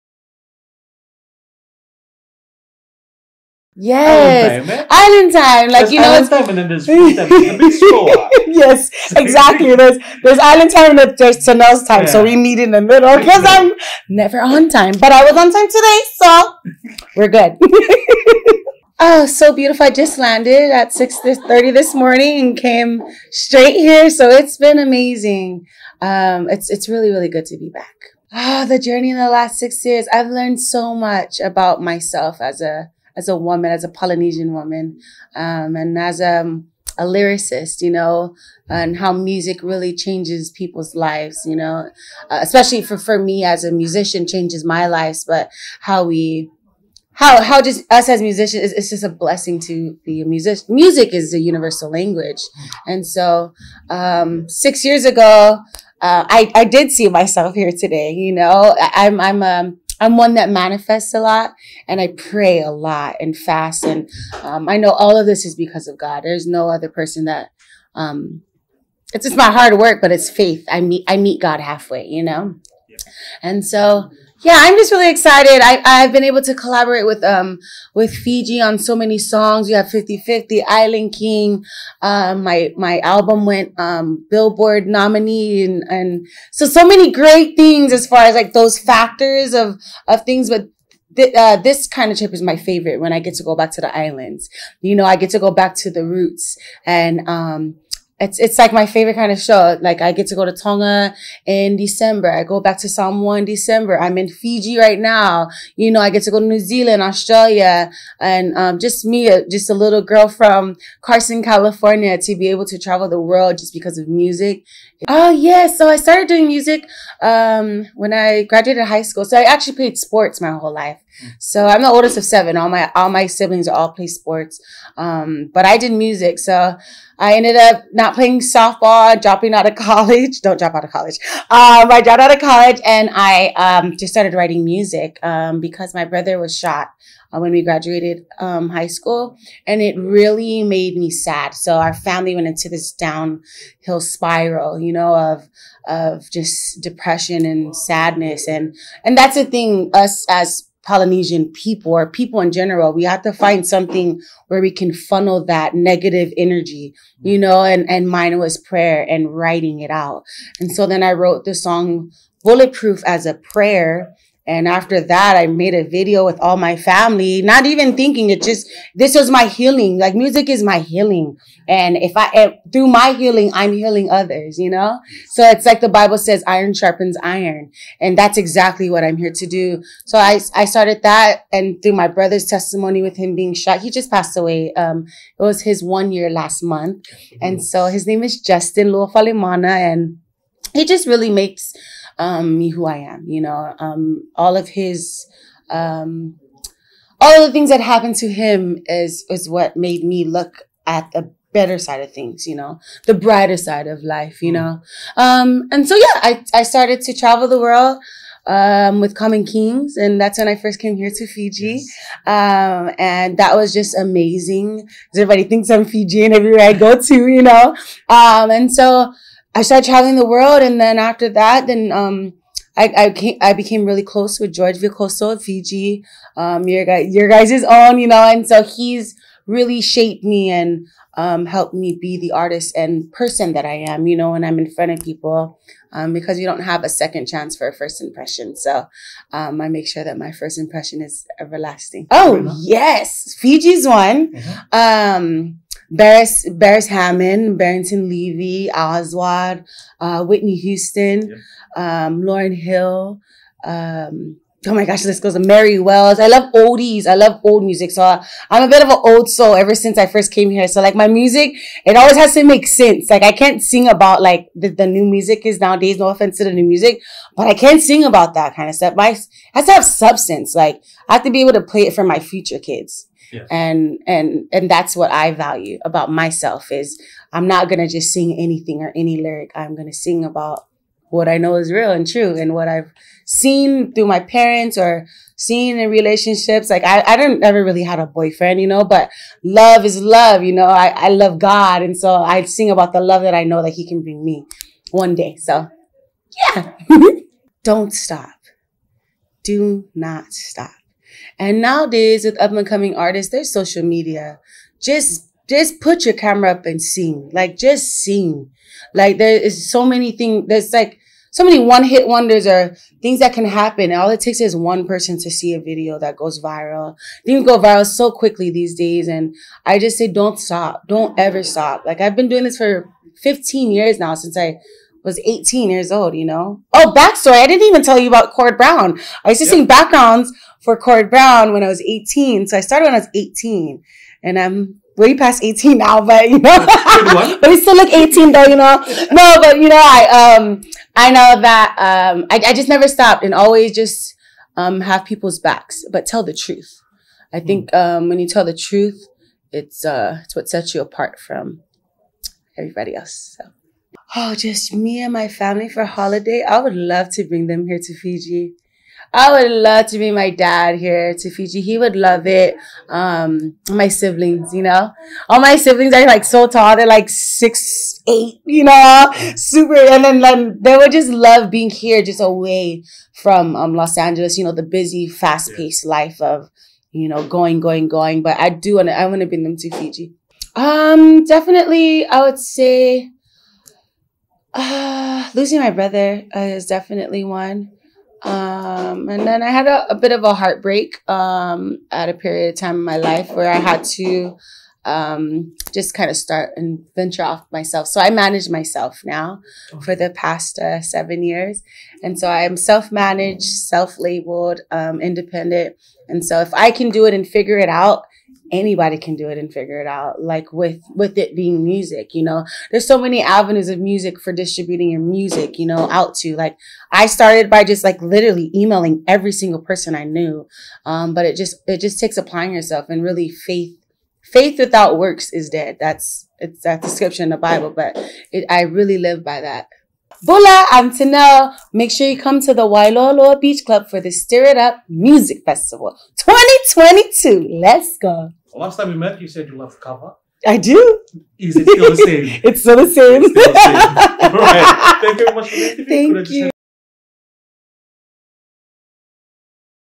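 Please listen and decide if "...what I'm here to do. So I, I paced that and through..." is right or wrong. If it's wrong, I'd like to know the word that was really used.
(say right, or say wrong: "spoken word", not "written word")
wrong: "started", not "paced".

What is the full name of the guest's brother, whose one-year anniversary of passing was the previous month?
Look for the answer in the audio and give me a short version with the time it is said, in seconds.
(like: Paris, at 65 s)
Justin Luafalemana, at 188 s.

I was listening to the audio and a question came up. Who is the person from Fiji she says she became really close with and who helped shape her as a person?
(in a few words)
George Veikoso.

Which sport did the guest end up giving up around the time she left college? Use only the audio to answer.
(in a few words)
Softball.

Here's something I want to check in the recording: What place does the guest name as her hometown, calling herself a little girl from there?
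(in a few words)
Carson, California.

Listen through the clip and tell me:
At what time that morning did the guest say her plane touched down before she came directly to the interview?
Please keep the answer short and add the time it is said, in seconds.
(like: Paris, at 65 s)
6:30, at 20 s.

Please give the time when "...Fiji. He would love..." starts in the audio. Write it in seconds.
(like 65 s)
361 s.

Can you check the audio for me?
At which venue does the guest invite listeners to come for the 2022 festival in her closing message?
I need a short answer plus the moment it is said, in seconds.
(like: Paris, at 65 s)
Wailoa Beach Club, at 432 s.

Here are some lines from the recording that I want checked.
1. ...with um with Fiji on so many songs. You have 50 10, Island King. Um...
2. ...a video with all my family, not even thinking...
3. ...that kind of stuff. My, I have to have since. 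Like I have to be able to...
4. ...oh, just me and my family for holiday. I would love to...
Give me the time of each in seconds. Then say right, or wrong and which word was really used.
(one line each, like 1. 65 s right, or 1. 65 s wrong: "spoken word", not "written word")
1. 77 s wrong: "50", not "10"
2. 165 s right
3. 268 s wrong: "substance", not "since"
4. 354 s right.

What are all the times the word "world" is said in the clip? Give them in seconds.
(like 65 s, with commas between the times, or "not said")
113 s, 207 s, 220 s.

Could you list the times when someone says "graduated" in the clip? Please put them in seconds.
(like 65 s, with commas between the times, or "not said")
118 s, 137 s.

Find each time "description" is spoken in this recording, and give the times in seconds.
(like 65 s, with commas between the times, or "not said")
426 s.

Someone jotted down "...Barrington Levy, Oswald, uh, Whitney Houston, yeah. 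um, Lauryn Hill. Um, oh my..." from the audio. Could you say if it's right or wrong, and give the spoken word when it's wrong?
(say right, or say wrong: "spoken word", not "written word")
right.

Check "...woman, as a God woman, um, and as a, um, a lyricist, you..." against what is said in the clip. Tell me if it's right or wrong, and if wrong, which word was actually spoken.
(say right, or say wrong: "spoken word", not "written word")
wrong: "Polynesian", not "God".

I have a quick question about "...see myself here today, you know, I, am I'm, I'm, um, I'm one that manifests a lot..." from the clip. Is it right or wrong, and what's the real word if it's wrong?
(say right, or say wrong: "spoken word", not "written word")
right.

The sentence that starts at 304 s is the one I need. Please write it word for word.
Just just put your camera up and sing.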